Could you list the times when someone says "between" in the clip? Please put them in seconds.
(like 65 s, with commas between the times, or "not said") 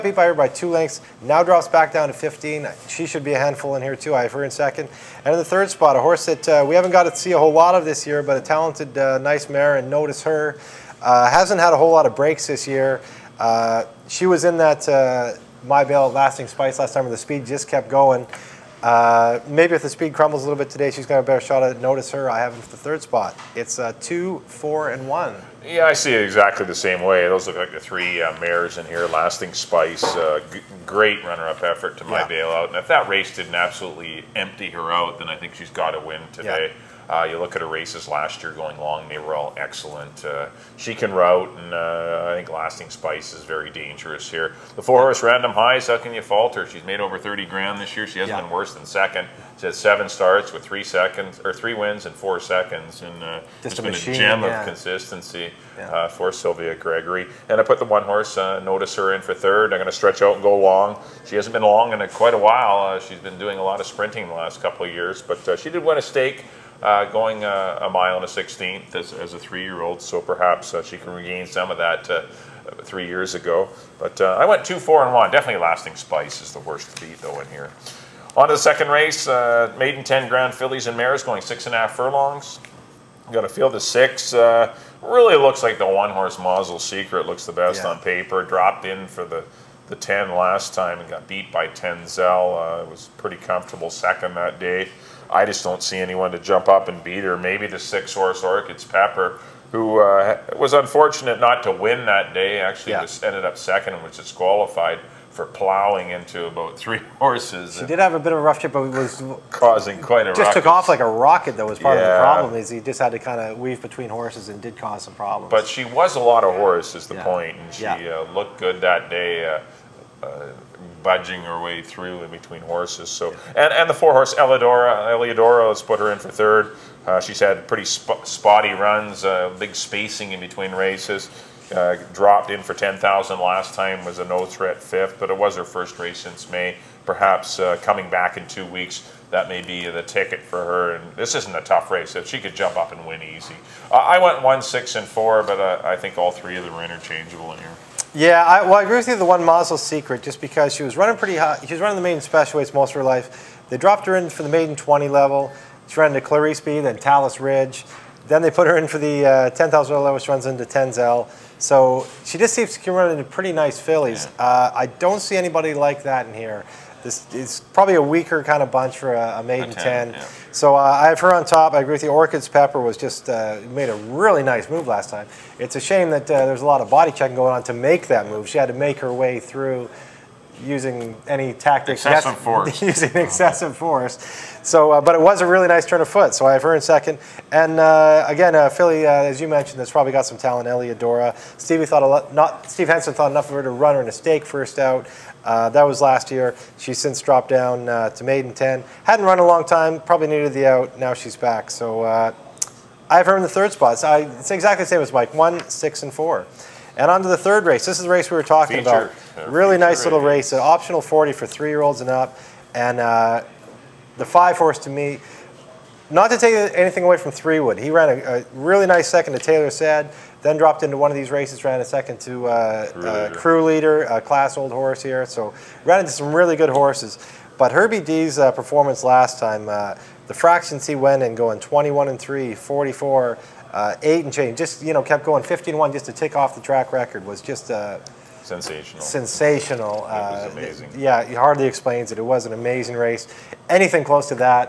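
113 s, 122 s, 130 s.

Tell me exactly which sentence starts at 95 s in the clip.
I just don't see anyone to jump up and beat her.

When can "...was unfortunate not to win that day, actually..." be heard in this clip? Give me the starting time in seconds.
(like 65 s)
100 s.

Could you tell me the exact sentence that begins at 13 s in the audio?
Uh, she was in that uh, My Bell Lasting Spice last time, where the speed just kept going.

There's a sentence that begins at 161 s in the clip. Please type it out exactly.
So she just seems to can run into pretty nice fillies.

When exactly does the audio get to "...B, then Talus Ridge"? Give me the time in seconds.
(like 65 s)
156 s.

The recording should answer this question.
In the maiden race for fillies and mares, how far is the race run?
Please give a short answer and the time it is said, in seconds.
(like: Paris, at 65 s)
6 and a half furlongs, at 81 s.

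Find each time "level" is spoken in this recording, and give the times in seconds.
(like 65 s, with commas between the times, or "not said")
155 s, 159 s.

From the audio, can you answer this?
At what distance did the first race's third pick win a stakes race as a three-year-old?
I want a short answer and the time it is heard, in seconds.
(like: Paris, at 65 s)
a mile and a sixteenth, at 67 s.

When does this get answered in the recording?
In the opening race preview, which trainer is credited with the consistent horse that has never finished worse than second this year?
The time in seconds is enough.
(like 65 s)
56 s.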